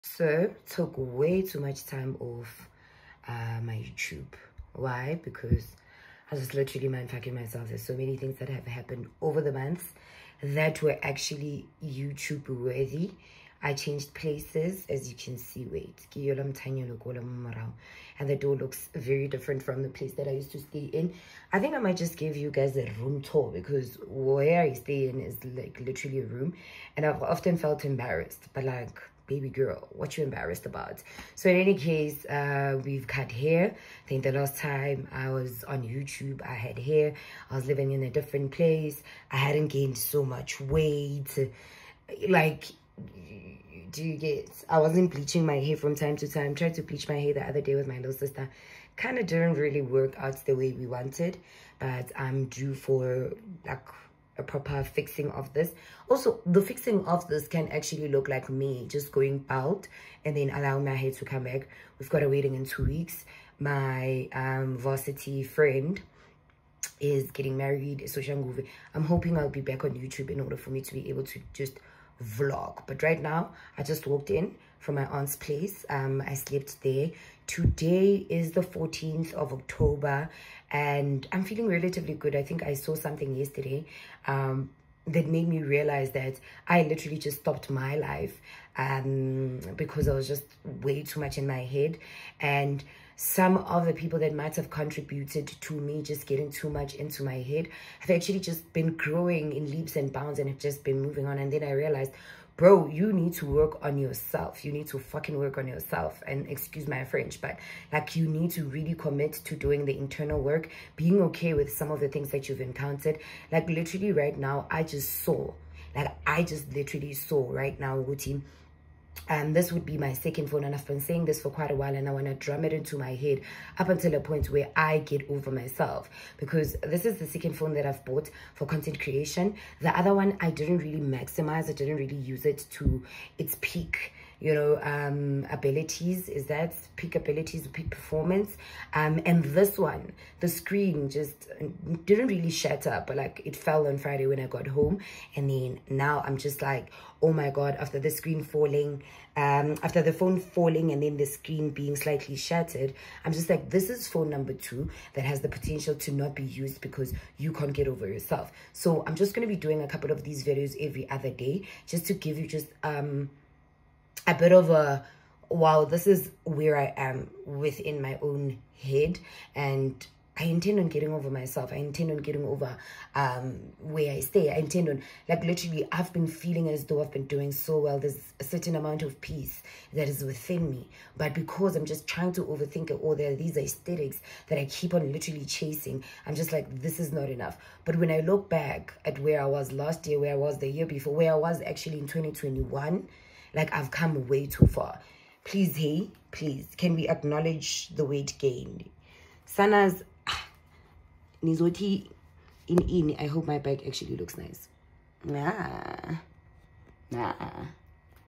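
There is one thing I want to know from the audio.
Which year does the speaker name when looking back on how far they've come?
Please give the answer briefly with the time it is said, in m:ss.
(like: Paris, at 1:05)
2021, at 3:12.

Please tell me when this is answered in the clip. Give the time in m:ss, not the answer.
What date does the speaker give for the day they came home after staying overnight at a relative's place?
1:18.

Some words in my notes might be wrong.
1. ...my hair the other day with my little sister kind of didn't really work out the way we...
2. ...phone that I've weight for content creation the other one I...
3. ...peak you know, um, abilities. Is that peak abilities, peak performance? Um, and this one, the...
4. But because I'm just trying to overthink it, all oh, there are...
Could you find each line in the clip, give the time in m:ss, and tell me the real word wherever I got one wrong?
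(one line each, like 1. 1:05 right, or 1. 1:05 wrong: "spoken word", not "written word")
1. 0:47 right
2. 2:07 wrong: "bought", not "weight"
3. 2:13 right
4. 3:01 right.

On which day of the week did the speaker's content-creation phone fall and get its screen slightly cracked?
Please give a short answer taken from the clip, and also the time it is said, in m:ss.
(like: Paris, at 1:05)
Friday, at 2:23.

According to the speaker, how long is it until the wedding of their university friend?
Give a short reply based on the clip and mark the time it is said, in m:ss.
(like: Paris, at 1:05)
2 weeks, at 1:02.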